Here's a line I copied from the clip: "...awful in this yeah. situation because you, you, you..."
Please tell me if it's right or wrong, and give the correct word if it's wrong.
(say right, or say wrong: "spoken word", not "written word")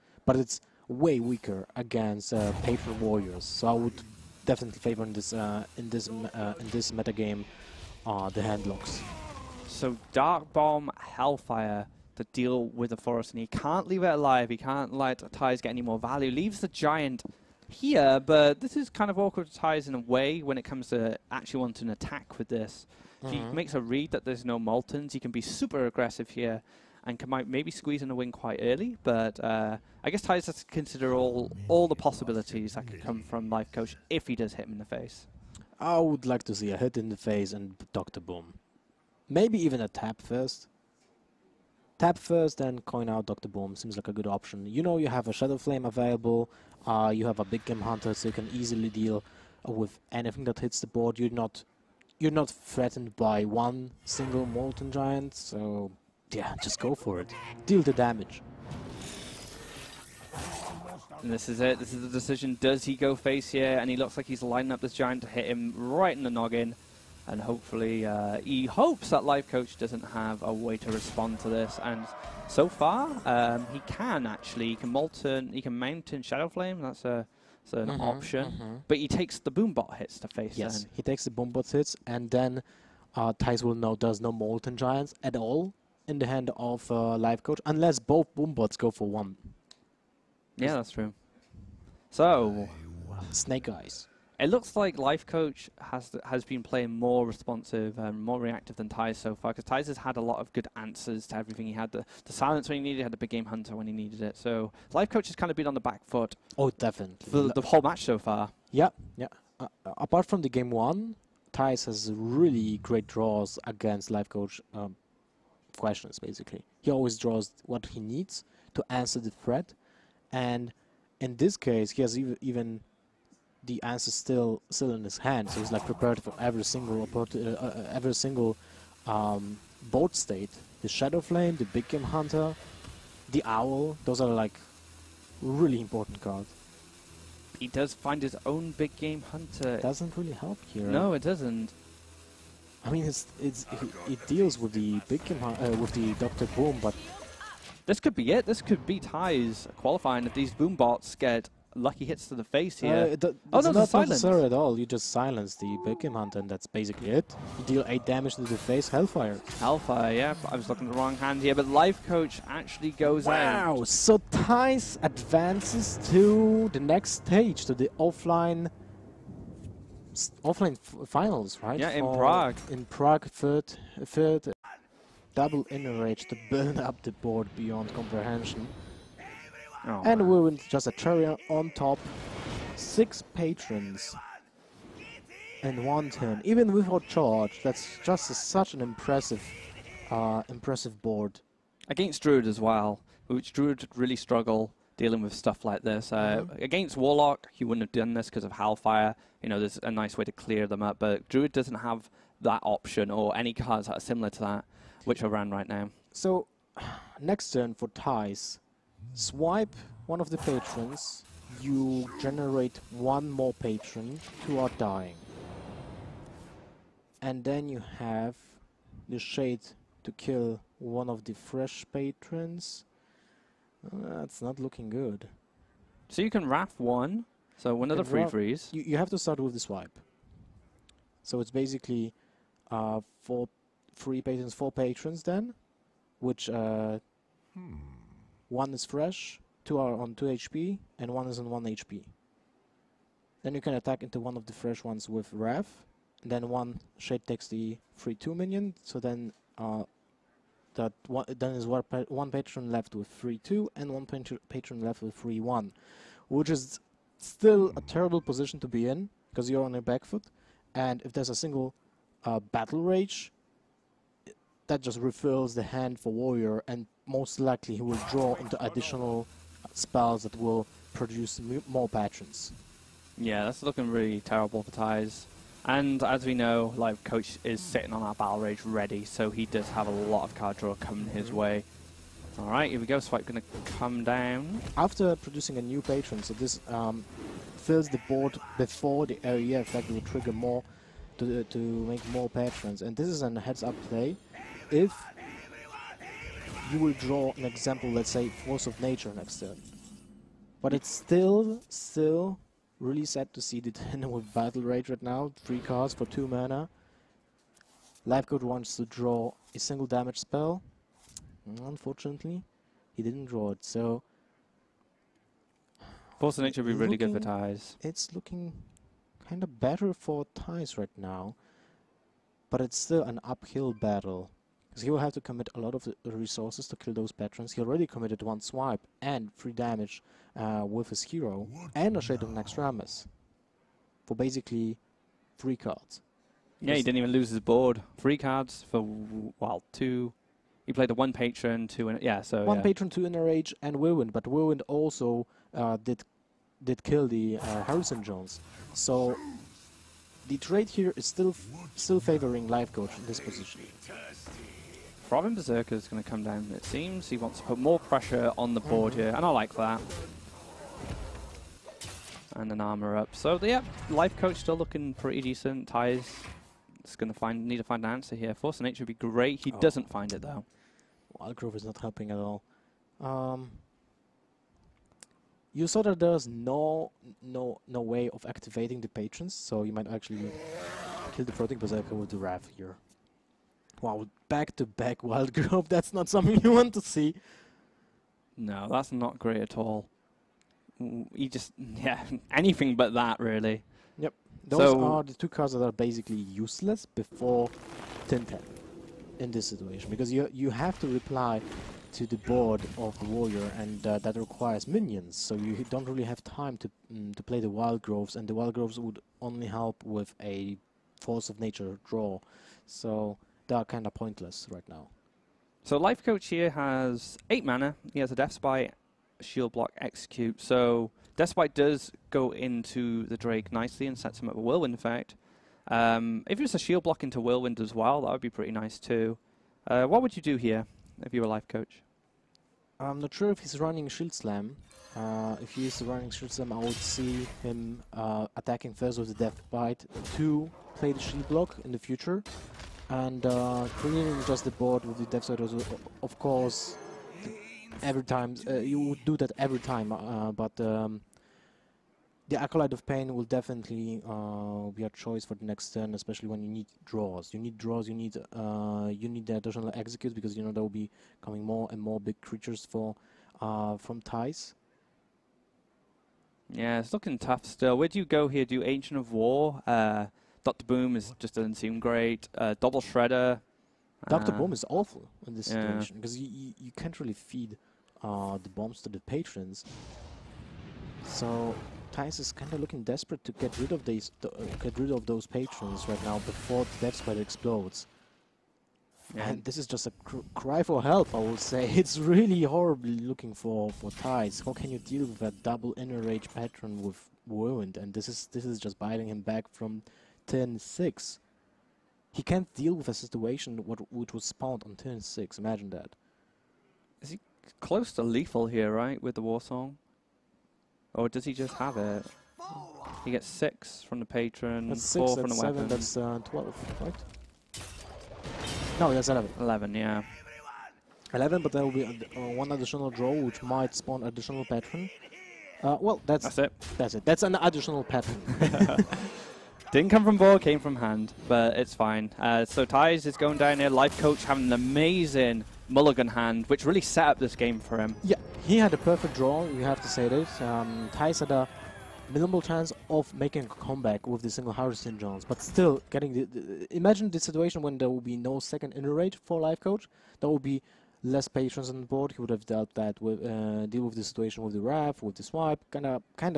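right.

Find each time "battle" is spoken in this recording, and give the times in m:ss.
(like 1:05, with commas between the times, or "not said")
4:22, 4:38, 5:04, 5:23.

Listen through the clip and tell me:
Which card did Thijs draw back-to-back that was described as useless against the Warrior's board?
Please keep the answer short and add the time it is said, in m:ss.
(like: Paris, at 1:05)
Wild Growth, at 6:11.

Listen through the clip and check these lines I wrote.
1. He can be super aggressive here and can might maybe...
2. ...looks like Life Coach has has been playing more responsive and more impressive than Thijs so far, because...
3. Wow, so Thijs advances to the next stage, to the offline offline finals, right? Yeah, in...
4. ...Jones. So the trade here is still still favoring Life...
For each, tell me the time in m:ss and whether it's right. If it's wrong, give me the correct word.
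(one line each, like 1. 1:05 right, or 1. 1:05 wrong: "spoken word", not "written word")
1. 0:25 right
2. 1:34 wrong: "reactive", not "impressive"
3. 2:43 right
4. 5:48 right.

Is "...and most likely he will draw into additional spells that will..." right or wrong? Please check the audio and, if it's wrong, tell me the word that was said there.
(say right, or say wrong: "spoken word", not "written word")
right.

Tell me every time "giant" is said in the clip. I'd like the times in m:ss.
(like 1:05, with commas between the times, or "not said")
0:16, 0:54, 1:04, 1:24.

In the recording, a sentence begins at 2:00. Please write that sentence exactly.
And in this case, he has ev even the answer still still in his hand.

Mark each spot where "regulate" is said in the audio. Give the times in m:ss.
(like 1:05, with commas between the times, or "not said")
not said.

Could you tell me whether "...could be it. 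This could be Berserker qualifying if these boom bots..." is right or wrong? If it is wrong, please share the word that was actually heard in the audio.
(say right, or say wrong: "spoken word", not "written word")
wrong: "Thijs", not "Berserker".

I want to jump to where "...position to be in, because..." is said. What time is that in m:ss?
4:18.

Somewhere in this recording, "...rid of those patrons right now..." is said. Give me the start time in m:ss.
8:04.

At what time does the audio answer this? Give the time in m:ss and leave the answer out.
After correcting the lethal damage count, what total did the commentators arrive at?
8:39.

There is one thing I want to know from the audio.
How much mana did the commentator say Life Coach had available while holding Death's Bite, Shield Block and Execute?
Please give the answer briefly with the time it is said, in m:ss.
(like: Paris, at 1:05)
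8, at 6:57.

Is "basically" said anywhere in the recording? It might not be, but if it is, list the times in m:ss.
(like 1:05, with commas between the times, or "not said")
1:56, 2:36, 3:51, 5:34, 6:35.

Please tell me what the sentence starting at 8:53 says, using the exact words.
Life Coach having an amazing mulligan hand, which really set up this game for him.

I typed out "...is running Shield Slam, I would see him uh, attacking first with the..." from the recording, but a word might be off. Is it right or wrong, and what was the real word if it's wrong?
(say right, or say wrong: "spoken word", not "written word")
right.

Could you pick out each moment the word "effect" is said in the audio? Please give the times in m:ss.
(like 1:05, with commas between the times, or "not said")
4:49, 7:04.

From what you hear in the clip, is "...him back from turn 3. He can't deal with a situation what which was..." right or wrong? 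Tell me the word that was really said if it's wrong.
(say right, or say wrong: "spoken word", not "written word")
wrong: "6", not "3".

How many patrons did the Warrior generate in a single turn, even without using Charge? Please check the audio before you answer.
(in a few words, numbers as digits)
6.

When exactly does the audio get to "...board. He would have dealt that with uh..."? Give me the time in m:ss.
9:11.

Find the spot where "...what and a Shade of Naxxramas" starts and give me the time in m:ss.
5:31.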